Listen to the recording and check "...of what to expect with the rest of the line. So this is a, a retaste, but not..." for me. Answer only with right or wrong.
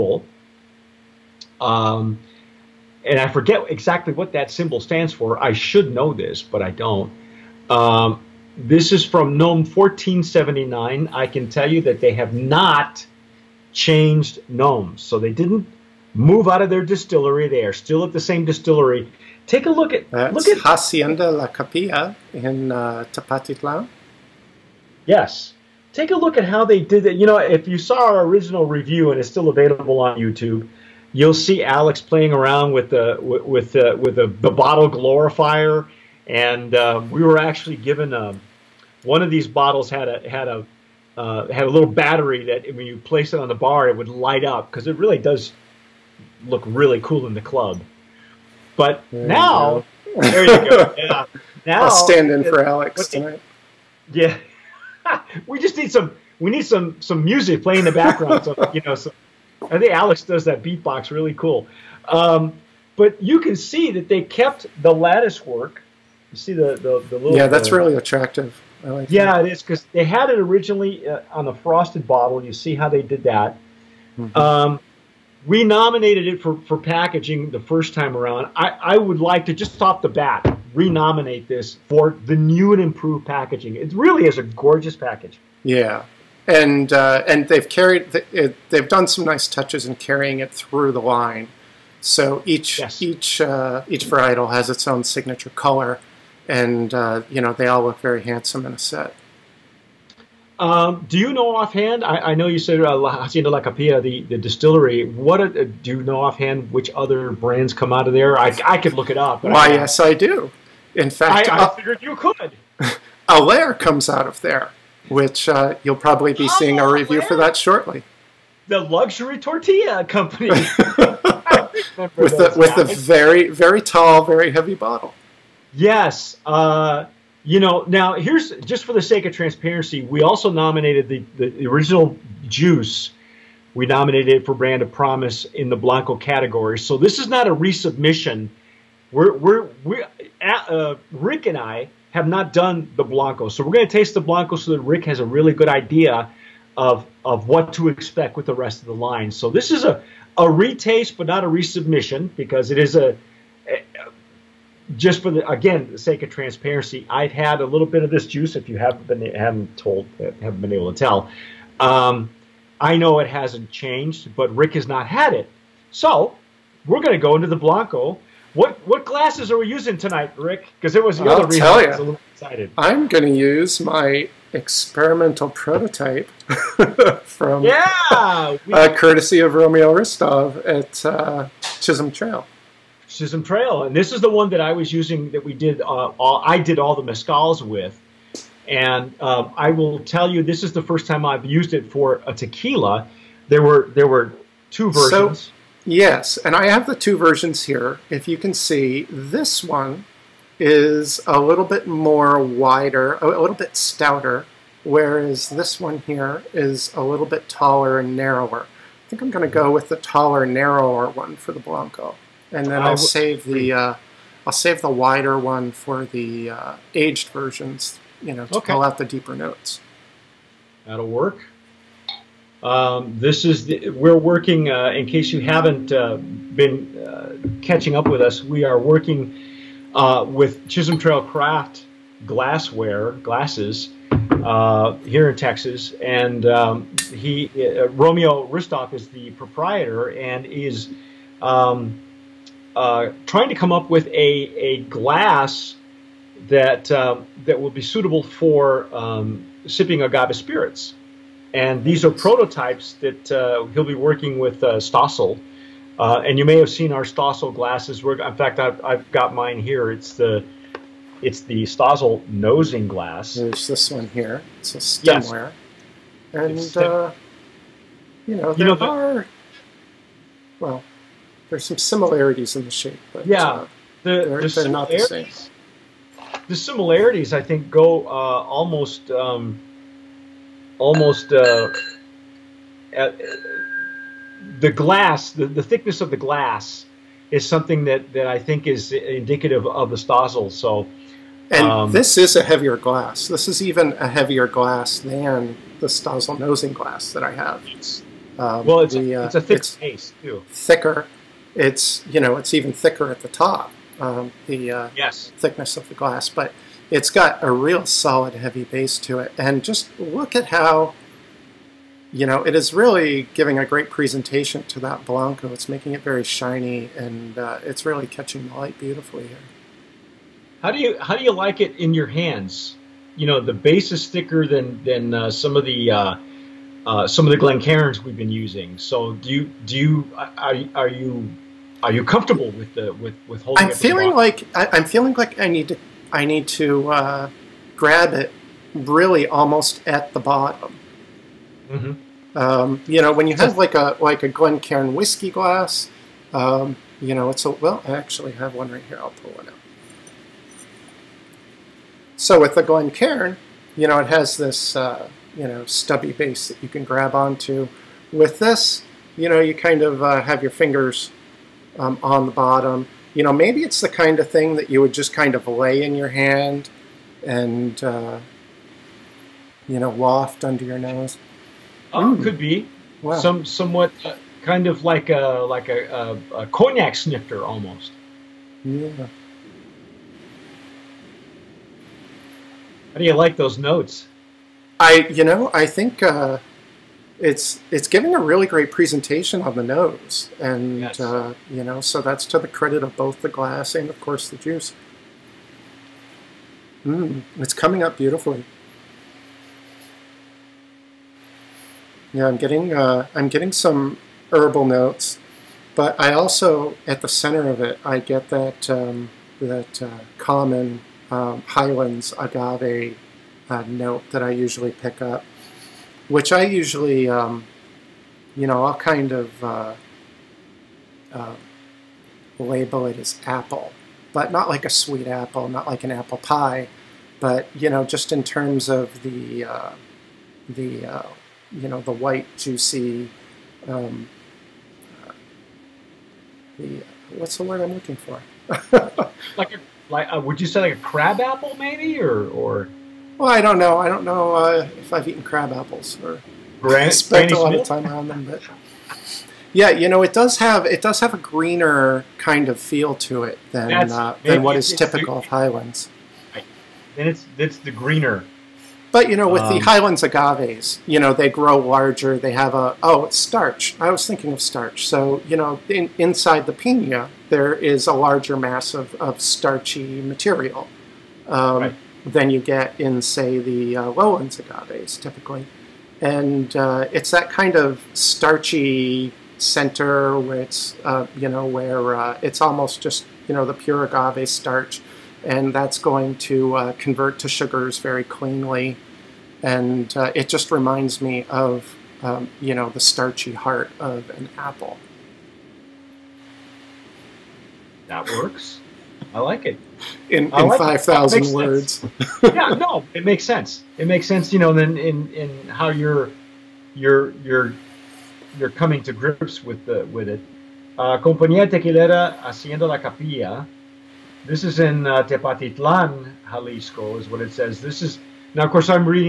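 right.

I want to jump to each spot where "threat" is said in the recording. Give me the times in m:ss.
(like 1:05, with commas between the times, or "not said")
not said.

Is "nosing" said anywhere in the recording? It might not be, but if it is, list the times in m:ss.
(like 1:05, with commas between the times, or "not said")
4:22, 4:56.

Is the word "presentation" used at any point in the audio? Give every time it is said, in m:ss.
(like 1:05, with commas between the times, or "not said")
5:13, 6:28.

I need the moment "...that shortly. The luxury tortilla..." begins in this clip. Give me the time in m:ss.
1:57.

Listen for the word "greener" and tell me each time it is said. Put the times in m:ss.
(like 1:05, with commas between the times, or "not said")
7:31, 7:37.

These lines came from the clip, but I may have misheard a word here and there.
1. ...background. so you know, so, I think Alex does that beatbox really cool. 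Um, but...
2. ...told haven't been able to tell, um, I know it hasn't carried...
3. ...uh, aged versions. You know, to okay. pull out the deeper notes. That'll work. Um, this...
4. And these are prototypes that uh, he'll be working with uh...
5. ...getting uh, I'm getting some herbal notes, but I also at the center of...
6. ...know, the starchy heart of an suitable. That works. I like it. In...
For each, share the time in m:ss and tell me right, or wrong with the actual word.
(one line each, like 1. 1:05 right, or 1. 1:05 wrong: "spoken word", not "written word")
1. 0:57 right
2. 2:39 wrong: "changed", not "carried"
3. 3:36 right
4. 4:11 right
5. 6:42 right
6. 8:12 wrong: "apple", not "suitable".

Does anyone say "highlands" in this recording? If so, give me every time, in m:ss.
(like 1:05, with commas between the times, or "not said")
6:51, 7:35, 7:39.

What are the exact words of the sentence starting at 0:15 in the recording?
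So they didn't move out of their distillery.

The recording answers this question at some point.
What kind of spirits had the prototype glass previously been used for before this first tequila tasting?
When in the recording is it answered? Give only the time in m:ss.
3:07.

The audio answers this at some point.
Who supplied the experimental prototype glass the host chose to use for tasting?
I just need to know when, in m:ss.
2:59.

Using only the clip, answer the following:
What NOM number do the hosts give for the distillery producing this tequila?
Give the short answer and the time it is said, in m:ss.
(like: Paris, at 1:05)
1479, at 0:09.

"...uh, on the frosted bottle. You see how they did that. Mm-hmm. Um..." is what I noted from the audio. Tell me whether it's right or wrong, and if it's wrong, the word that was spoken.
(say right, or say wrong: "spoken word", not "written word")
right.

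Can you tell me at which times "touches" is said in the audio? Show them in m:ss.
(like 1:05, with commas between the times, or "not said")
1:29.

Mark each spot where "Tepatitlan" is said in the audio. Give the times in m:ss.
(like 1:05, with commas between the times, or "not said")
0:23, 8:35.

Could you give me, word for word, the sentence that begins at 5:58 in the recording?
With this, you know, you kind of uh, have your fingers um, on the bottom.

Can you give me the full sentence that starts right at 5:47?
I actually have one right here.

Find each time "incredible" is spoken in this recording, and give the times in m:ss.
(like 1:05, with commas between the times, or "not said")
not said.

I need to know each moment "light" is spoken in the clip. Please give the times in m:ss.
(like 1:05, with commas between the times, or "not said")
0:44, 5:18.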